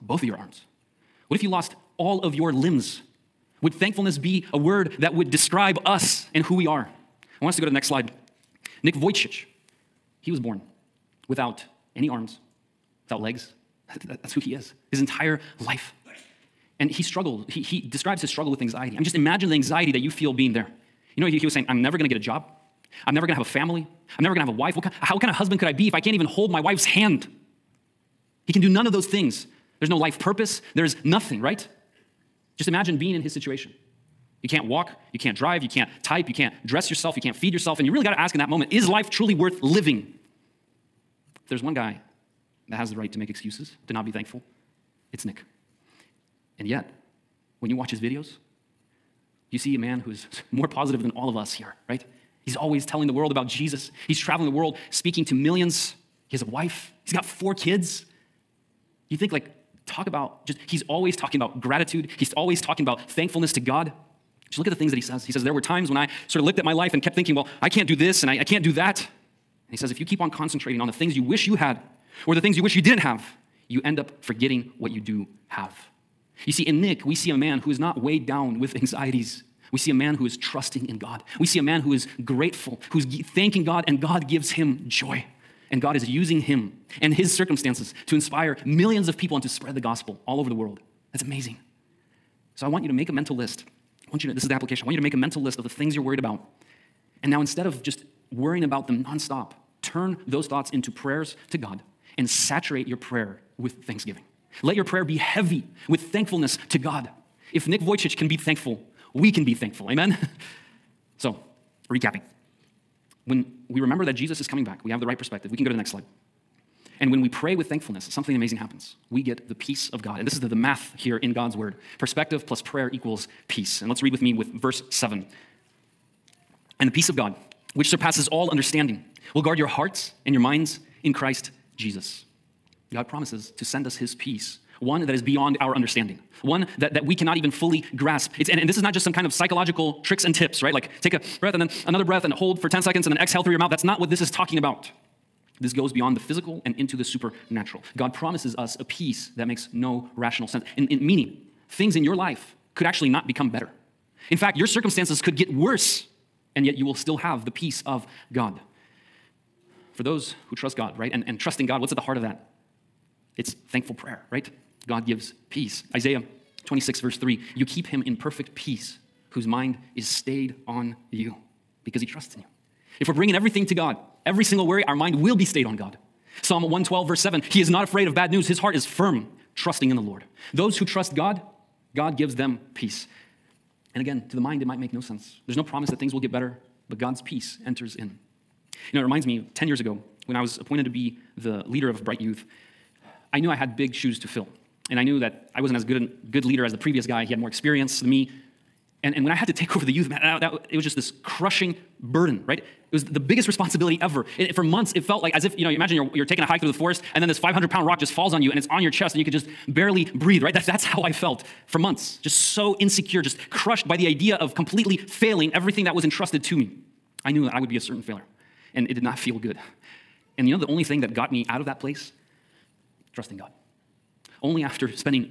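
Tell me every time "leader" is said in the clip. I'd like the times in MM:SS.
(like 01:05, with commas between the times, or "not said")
03:11, 03:16.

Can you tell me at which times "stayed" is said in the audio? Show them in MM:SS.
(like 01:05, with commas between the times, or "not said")
02:50, 02:55.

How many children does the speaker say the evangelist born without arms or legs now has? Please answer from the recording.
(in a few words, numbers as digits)
4.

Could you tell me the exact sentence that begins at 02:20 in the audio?
Like take a breath and then another breath and hold for 10 seconds and then exhale through your mouth.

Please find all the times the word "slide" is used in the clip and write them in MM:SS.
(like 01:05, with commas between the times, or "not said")
00:07, 01:55.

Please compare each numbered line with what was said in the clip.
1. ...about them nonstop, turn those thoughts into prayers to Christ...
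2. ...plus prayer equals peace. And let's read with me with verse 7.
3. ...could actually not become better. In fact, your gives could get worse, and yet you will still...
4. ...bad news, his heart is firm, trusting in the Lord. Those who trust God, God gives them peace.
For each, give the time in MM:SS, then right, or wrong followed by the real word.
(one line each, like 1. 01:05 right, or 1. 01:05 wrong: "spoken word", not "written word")
1. 01:38 wrong: "God", not "Christ"
2. 02:02 right
3. 02:32 wrong: "circumstances", not "gives"
4. 02:58 right.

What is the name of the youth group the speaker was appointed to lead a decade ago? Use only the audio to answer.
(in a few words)
Bryte Youth.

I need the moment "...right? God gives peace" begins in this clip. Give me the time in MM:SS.
02:44.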